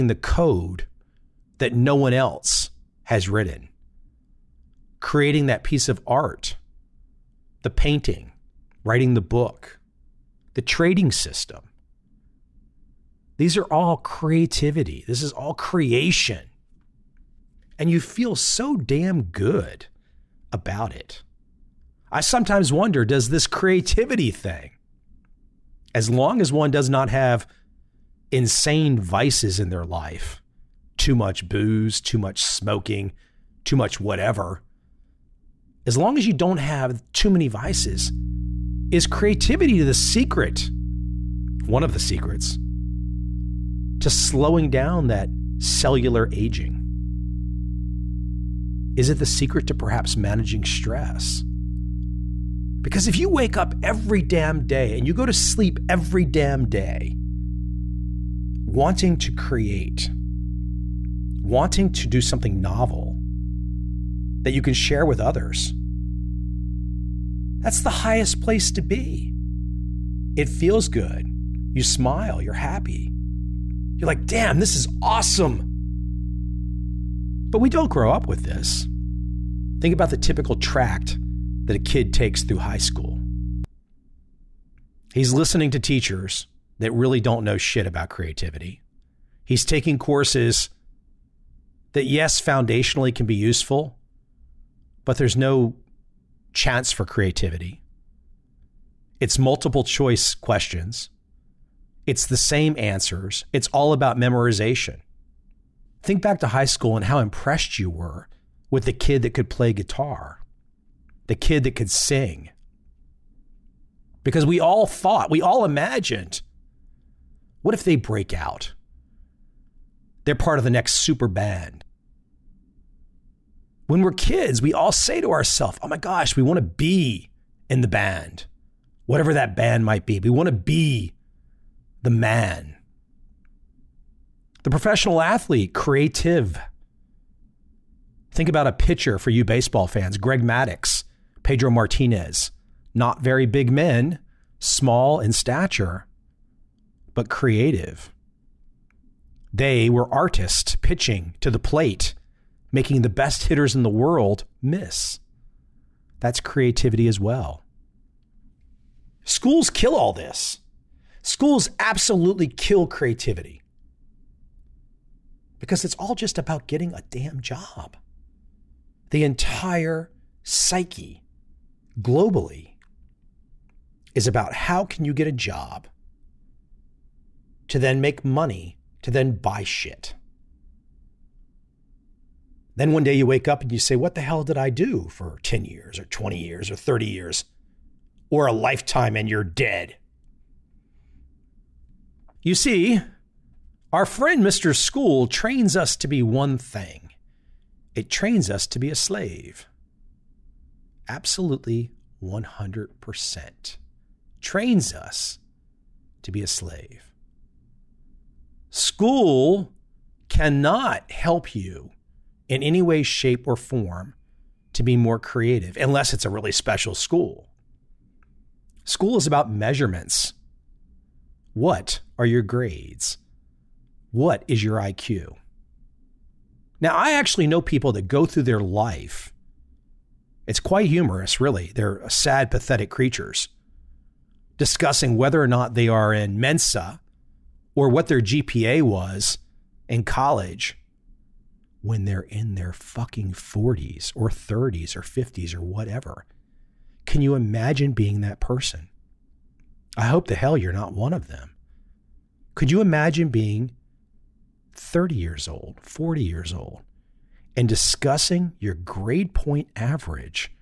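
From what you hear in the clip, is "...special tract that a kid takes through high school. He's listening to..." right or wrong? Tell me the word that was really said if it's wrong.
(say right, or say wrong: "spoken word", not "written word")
wrong: "typical", not "special".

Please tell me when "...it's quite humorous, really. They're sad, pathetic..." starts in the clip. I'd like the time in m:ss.
3:50.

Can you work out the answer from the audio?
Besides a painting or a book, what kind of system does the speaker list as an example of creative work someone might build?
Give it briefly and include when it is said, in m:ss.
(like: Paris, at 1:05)
trading system, at 0:10.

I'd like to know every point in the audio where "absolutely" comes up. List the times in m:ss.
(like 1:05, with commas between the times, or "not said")
2:41, 3:21.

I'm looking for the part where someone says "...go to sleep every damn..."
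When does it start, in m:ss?
0:55.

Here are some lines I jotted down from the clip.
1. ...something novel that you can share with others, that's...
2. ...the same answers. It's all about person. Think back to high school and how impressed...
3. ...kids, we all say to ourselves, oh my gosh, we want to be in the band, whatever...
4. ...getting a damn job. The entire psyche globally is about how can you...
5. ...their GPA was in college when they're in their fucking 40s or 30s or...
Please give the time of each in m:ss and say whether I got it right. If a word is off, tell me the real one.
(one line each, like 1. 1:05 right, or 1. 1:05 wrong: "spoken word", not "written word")
1. 1:02 right
2. 1:42 wrong: "memorization", not "person"
3. 2:04 right
4. 2:46 right
5. 3:58 right.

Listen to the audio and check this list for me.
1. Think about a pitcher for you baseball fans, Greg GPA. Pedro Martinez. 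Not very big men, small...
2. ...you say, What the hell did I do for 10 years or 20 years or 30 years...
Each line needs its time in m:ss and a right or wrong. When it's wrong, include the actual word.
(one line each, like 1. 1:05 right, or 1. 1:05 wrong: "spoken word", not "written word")
1. 2:18 wrong: "Maddux", not "GPA"
2. 3:03 right.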